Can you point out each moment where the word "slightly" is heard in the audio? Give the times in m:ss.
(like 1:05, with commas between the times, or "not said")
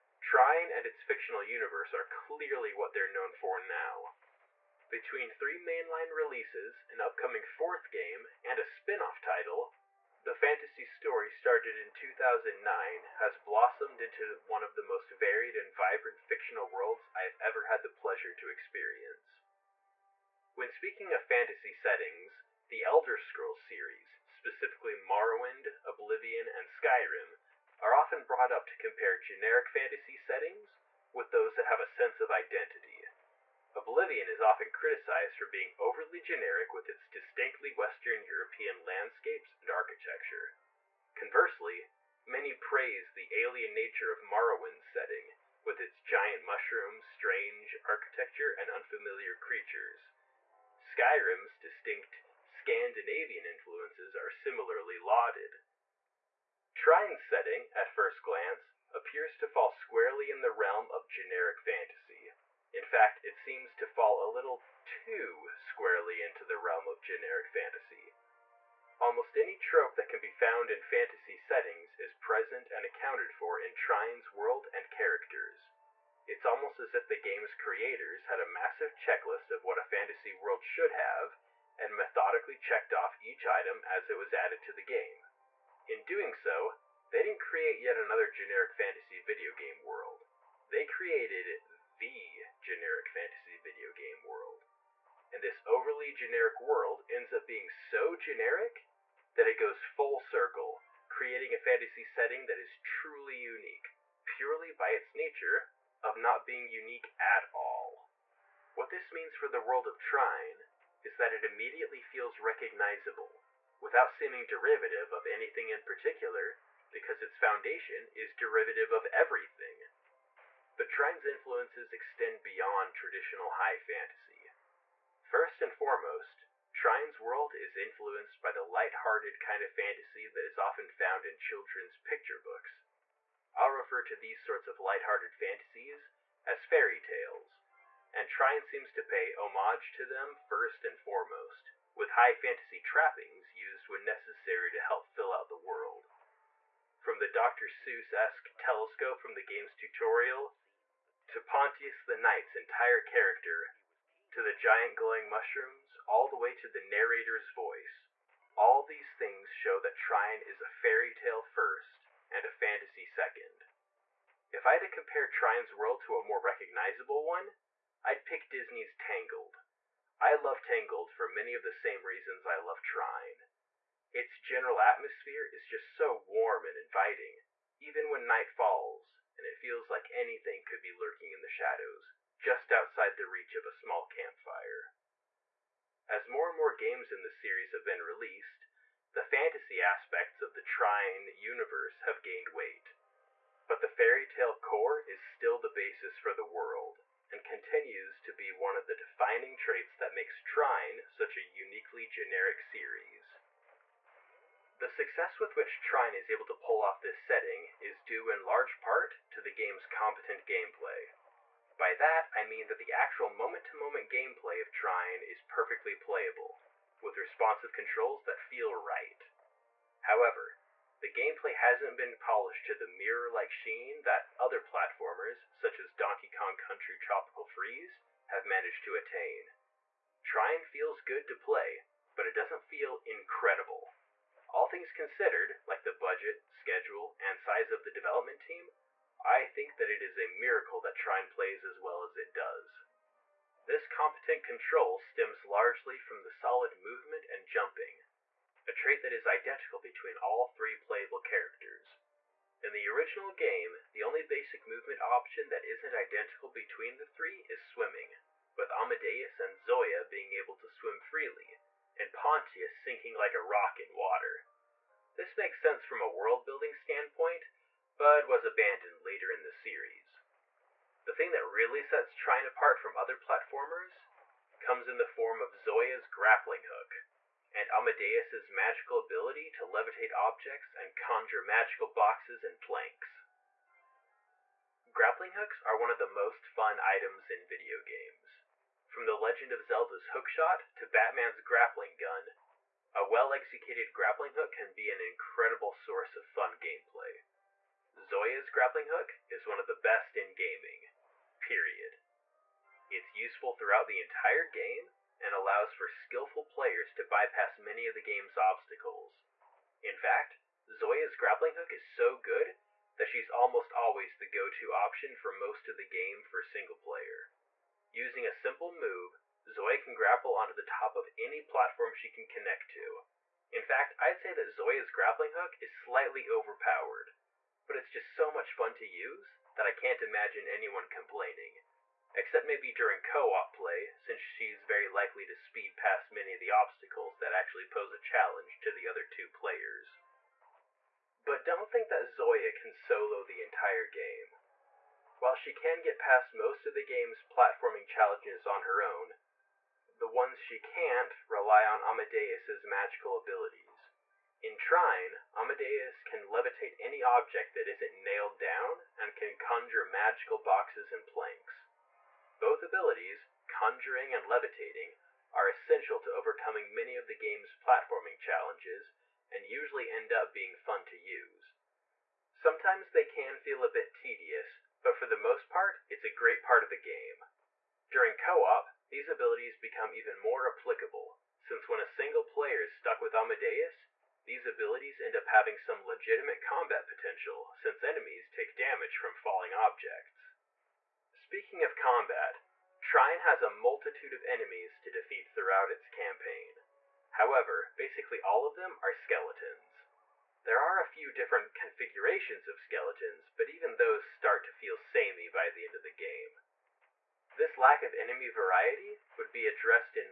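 5:25.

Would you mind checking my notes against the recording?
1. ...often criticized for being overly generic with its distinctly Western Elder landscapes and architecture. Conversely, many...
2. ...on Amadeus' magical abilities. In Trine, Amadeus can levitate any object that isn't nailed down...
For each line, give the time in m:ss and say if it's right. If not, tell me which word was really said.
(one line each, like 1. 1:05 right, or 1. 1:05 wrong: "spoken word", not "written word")
1. 0:34 wrong: "European", not "Elder"
2. 5:51 right.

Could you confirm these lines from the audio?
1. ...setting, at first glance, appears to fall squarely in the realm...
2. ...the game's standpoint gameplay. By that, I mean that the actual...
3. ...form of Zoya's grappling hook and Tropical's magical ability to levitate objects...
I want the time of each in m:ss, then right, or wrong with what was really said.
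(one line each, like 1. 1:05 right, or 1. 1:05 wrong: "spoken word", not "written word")
1. 0:57 right
2. 3:29 wrong: "competent", not "standpoint"
3. 4:35 wrong: "Amadeus", not "Tropical".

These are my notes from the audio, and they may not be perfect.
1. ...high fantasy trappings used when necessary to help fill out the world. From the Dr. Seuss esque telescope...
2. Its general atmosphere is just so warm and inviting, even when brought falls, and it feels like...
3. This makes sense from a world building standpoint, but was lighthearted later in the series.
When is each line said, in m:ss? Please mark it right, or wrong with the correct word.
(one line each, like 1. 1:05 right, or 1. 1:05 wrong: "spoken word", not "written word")
1. 2:22 right
2. 2:54 wrong: "night", not "brought"
3. 4:25 wrong: "abandoned", not "lighthearted".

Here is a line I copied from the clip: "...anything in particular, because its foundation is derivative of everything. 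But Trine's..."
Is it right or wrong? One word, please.
right.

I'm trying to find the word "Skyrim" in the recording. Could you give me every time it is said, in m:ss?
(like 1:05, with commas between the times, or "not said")
0:26, 0:50.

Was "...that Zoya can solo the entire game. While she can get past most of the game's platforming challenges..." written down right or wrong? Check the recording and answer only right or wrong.
right.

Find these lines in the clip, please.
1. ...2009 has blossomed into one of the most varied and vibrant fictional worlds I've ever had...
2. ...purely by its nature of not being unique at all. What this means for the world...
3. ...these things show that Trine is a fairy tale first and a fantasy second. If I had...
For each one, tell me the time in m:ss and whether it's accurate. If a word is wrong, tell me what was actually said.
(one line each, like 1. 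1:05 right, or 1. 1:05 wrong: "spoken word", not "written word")
1. 0:11 right
2. 1:44 right
3. 2:38 right.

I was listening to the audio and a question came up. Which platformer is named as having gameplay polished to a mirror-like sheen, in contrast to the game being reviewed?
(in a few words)
Donkey Kong Country Tropical Freeze.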